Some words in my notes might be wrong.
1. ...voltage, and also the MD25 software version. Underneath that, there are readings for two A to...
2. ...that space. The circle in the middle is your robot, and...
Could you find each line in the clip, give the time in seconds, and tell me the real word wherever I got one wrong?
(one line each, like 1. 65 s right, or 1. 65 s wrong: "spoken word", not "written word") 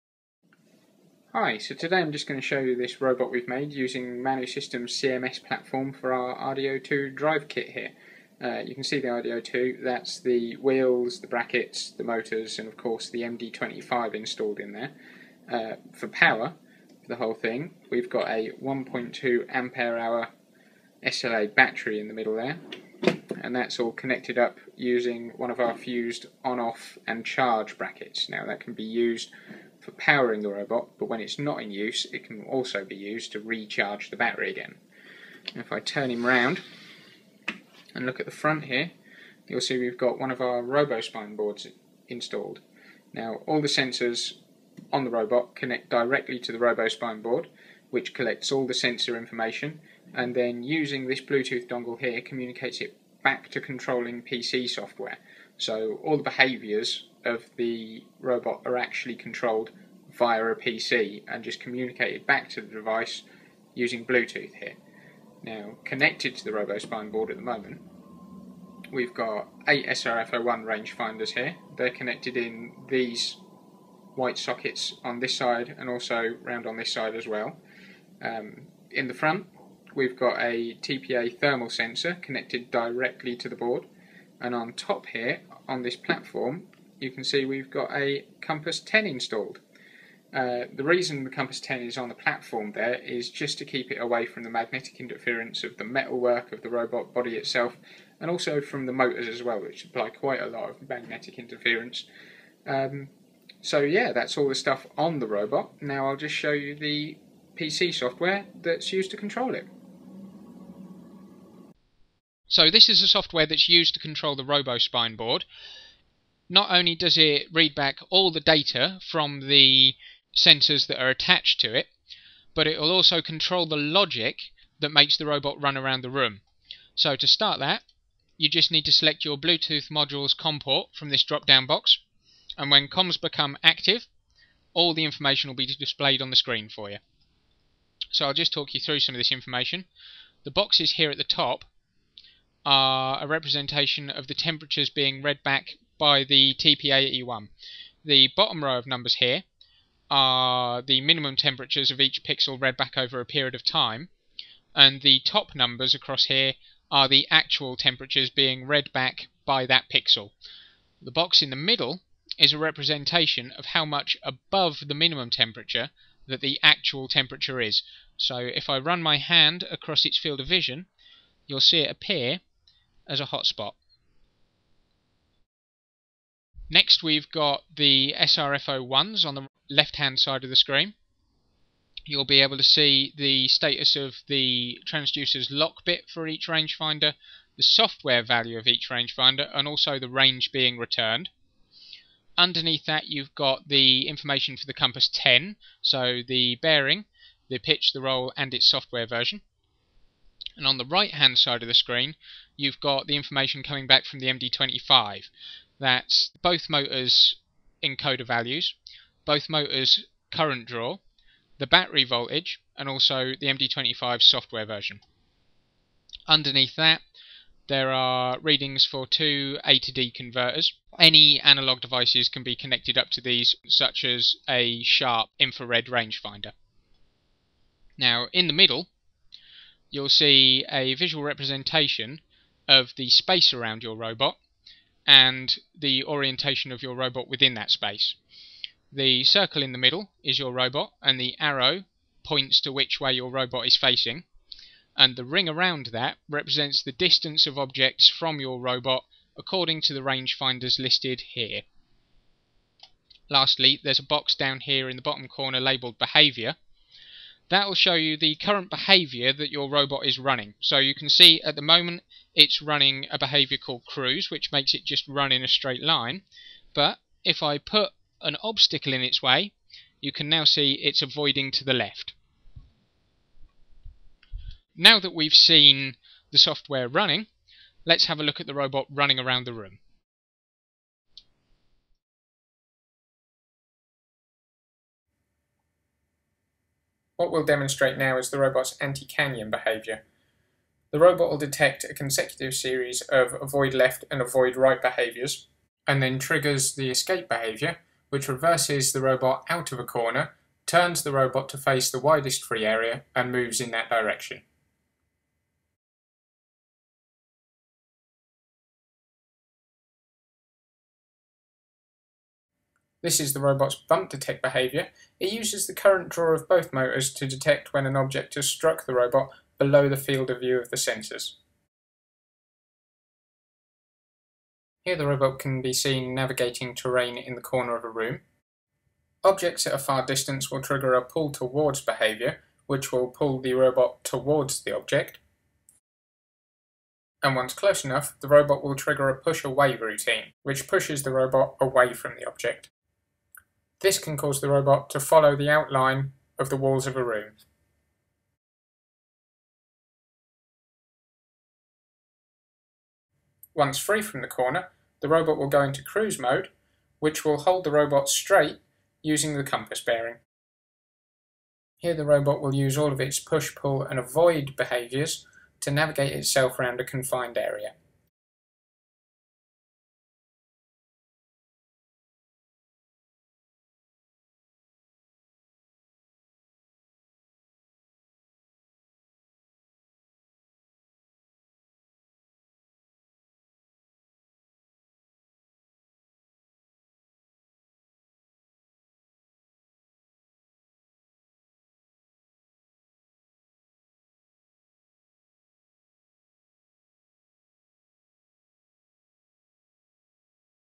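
1. 212 s right
2. 237 s right.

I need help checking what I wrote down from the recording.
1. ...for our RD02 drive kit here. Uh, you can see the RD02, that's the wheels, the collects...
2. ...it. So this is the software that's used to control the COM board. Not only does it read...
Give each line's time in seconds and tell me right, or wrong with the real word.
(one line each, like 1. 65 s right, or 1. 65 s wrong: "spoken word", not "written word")
1. 5 s wrong: "brackets", not "collects"
2. 109 s wrong: "RoboSpine", not "COM".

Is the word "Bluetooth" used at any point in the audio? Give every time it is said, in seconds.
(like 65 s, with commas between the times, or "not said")
51 s, 64 s, 129 s.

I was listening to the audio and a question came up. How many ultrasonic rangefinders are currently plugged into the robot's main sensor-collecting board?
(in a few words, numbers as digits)
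8.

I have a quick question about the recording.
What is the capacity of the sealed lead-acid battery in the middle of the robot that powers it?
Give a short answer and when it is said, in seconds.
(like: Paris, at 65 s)
1.2 ampere hour, at 18 s.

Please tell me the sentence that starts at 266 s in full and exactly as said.
But if I put an obstacle in its way, you can now see it's avoiding to the left.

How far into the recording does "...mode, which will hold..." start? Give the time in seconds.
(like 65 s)
356 s.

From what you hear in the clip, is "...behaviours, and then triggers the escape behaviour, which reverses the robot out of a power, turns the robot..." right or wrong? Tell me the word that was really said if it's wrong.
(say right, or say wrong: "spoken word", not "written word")
wrong: "corner", not "power".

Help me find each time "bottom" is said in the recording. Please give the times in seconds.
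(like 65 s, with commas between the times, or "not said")
148 s, 255 s.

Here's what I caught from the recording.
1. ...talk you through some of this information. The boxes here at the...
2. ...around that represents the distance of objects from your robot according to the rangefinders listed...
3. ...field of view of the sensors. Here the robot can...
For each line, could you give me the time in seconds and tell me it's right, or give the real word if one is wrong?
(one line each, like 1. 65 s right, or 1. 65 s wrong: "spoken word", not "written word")
1. 138 s right
2. 245 s right
3. 319 s right.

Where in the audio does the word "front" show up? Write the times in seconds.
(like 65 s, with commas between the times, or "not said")
38 s, 79 s.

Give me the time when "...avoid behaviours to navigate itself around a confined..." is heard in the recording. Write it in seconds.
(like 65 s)
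363 s.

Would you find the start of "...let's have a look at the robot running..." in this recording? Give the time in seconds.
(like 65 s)
277 s.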